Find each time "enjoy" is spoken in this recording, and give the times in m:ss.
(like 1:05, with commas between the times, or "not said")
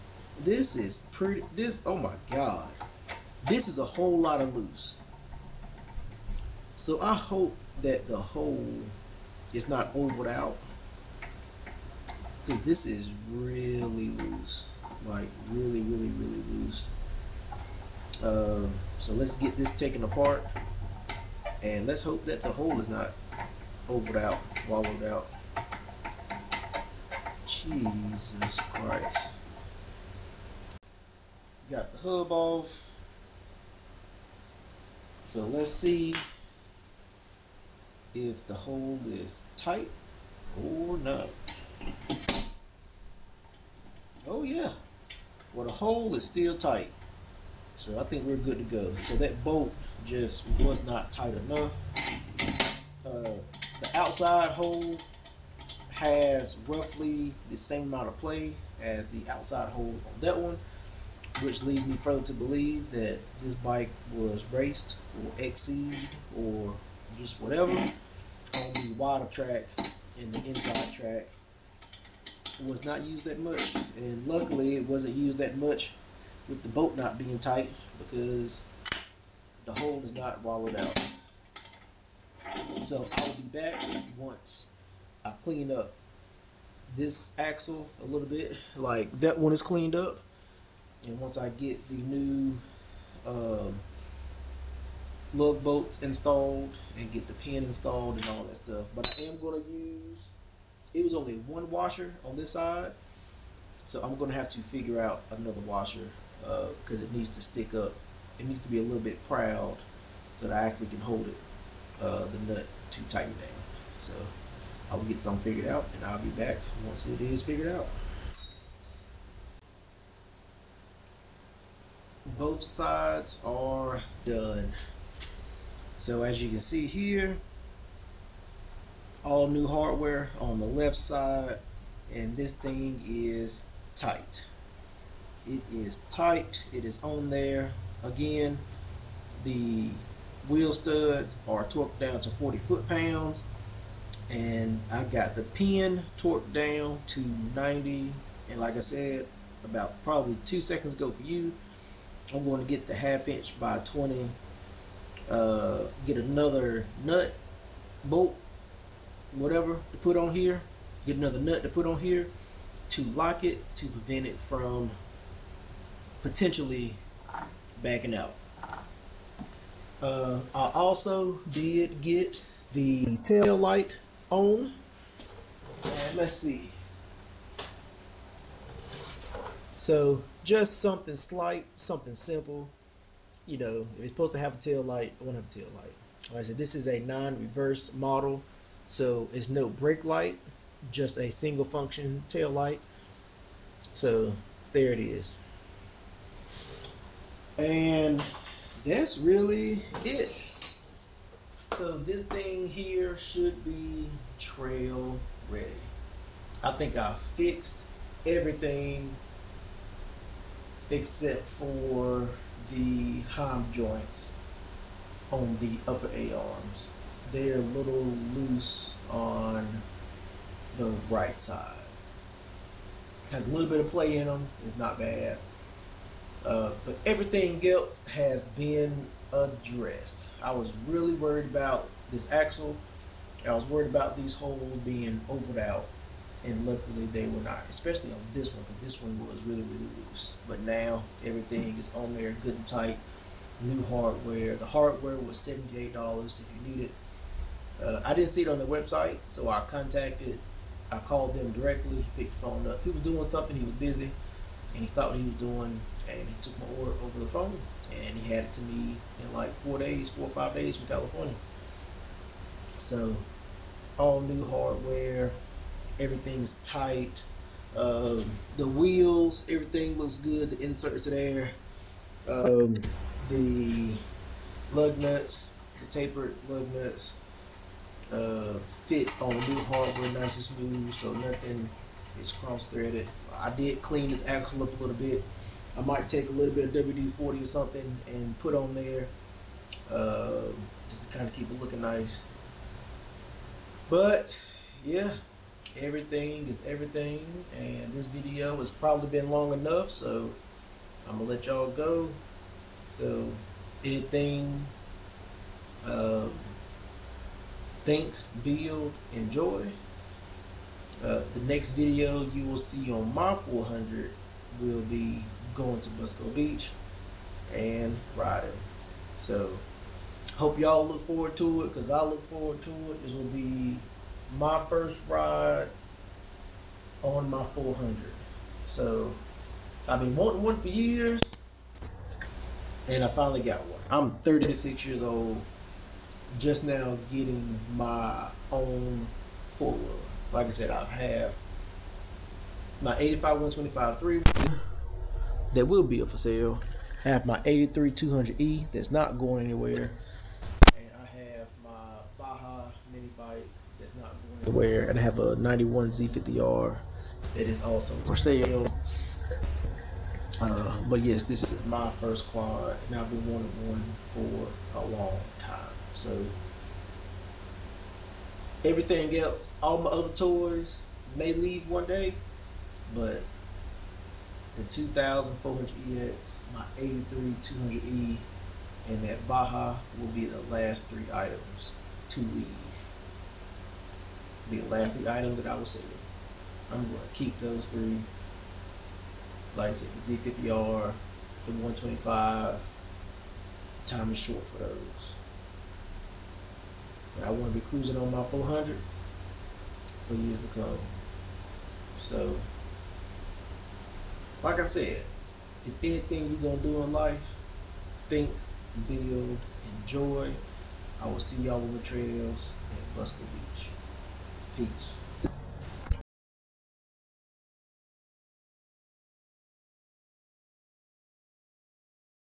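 5:09, 6:49.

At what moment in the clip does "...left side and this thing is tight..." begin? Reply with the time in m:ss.
2:10.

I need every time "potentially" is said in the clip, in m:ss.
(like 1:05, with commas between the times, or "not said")
2:46.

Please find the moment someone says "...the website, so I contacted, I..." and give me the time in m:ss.
4:08.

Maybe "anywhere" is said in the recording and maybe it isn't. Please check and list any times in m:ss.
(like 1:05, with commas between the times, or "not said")
5:49, 5:54.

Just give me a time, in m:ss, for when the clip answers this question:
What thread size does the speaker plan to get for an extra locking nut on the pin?
2:32.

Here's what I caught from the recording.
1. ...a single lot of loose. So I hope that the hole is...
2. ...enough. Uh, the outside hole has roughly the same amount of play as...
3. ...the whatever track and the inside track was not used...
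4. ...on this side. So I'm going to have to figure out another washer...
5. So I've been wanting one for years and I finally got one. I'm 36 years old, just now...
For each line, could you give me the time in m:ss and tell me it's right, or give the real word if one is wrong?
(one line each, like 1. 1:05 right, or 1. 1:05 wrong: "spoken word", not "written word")
1. 0:03 wrong: "whole", not "single"
2. 0:51 right
3. 1:08 wrong: "wider", not "whatever"
4. 1:42 right
5. 5:28 right.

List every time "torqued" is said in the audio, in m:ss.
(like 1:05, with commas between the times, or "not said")
2:21, 2:26.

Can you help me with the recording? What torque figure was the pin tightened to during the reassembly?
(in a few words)
90.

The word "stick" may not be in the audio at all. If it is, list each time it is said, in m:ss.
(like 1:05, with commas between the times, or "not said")
1:47.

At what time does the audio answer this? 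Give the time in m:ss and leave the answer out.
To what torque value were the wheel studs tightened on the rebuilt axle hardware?
2:22.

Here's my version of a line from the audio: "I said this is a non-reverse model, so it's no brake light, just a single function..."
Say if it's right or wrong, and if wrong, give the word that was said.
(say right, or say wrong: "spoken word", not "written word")
right.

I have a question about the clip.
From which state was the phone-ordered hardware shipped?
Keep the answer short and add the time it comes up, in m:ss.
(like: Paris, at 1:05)
California, at 4:20.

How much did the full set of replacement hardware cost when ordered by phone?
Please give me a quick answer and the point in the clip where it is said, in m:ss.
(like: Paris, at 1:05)
$78, at 4:05.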